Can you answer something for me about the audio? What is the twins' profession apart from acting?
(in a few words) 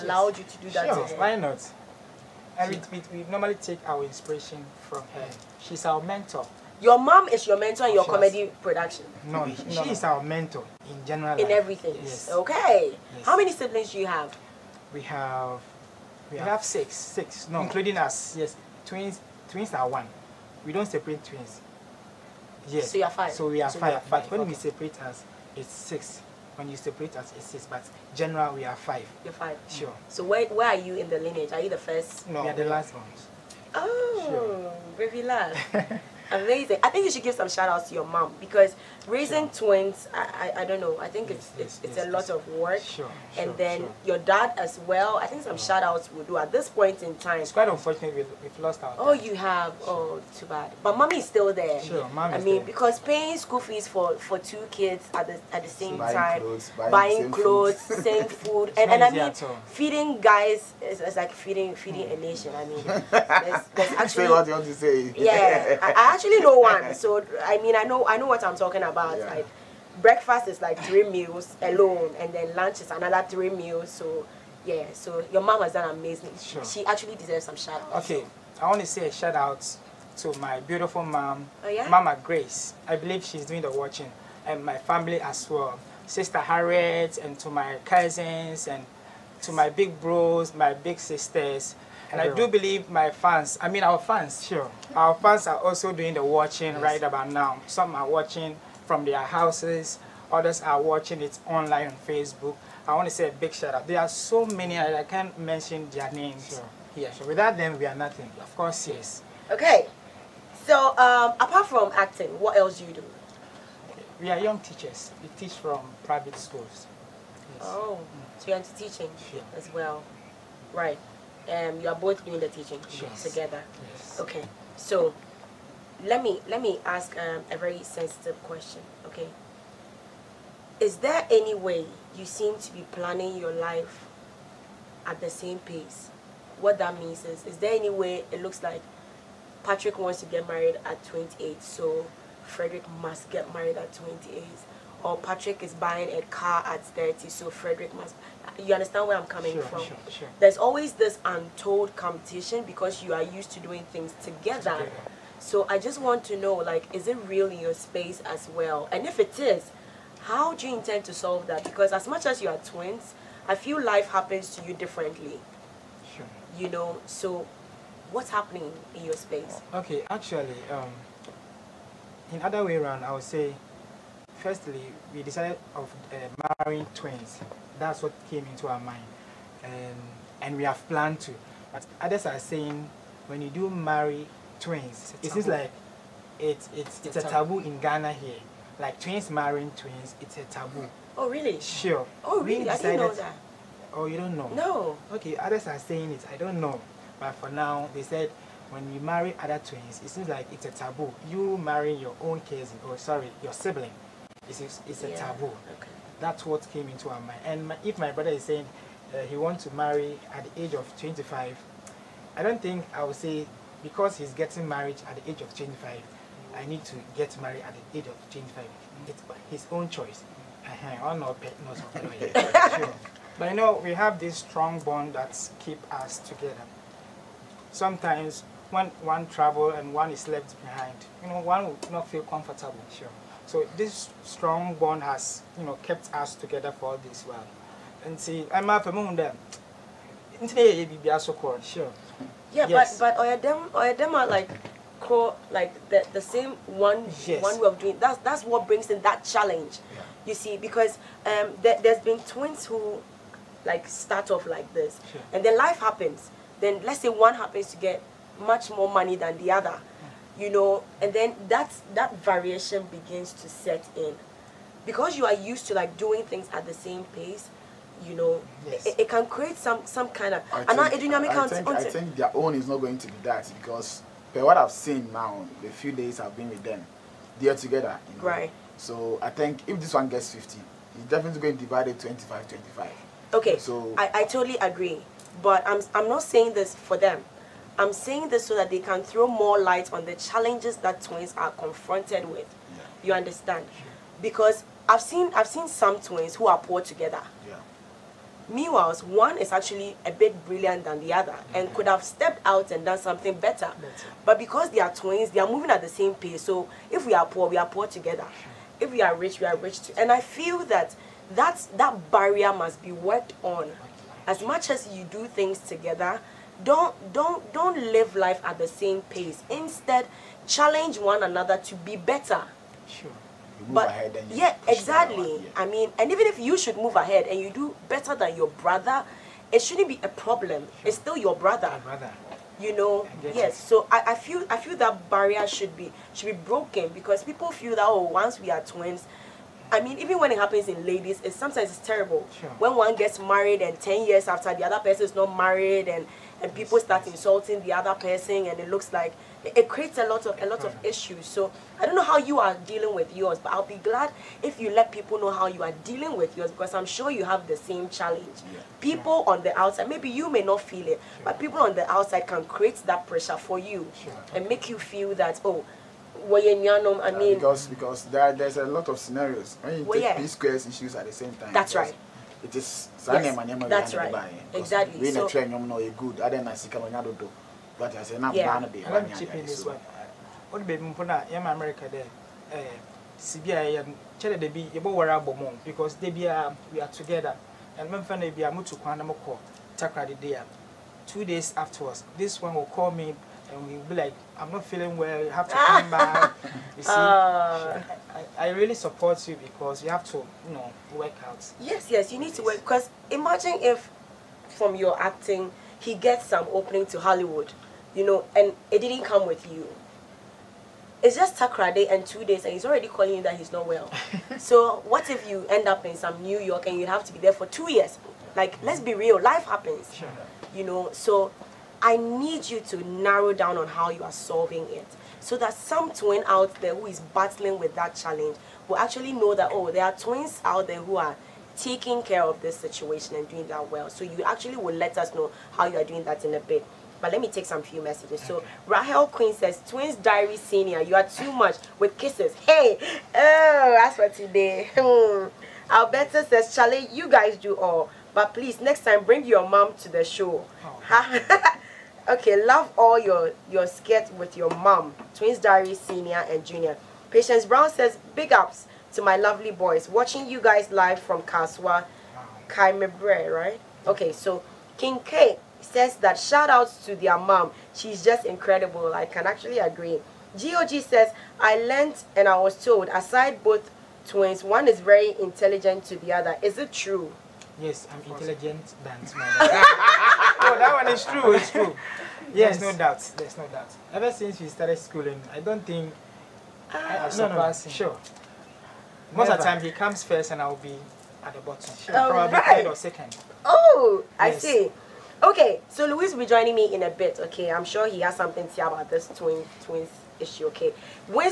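Teachers.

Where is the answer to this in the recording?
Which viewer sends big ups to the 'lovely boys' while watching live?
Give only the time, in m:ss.
7:37.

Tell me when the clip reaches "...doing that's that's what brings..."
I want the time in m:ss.
4:07.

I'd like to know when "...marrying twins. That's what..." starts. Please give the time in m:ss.
2:56.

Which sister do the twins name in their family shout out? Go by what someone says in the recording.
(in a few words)
Harriet.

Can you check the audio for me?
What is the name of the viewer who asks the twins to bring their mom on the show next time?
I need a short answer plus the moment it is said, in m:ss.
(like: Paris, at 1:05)
Alberta, at 7:25.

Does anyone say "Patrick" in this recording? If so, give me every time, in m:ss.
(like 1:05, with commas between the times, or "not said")
2:19, 2:25.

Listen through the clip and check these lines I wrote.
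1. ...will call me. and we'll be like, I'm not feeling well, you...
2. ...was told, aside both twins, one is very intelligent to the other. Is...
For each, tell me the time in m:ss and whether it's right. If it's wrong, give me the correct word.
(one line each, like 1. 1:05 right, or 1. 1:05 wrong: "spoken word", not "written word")
1. 6:32 right
2. 7:52 right.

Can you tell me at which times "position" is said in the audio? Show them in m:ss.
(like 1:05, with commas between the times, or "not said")
not said.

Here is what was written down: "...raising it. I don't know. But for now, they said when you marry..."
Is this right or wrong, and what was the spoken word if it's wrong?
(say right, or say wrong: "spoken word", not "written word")
wrong: "saying", not "raising".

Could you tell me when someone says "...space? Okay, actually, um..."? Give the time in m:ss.
2:49.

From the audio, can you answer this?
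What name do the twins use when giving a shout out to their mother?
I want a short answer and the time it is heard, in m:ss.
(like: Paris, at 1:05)
Mama Grace, at 1:21.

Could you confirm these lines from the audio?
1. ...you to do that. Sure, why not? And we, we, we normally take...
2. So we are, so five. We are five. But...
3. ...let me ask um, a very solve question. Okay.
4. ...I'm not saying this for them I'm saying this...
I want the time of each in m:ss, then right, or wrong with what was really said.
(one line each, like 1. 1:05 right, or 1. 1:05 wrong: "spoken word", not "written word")
1. 0:00 right
2. 0:23 right
3. 2:06 wrong: "sensitive", not "solve"
4. 4:45 right.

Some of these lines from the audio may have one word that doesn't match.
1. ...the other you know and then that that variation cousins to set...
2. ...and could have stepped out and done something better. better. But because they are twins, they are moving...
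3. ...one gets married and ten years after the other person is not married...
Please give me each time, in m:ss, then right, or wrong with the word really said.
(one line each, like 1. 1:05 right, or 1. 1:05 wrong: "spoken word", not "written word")
1. 4:19 wrong: "begins", not "cousins"
2. 5:01 right
3. 5:42 right.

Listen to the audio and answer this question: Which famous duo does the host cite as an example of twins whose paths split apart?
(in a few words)
P-Square.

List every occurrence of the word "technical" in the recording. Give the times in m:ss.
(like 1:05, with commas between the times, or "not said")
not said.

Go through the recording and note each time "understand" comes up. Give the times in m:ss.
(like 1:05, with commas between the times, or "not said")
2:28, 4:53.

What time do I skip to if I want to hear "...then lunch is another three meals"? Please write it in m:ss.
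1:12.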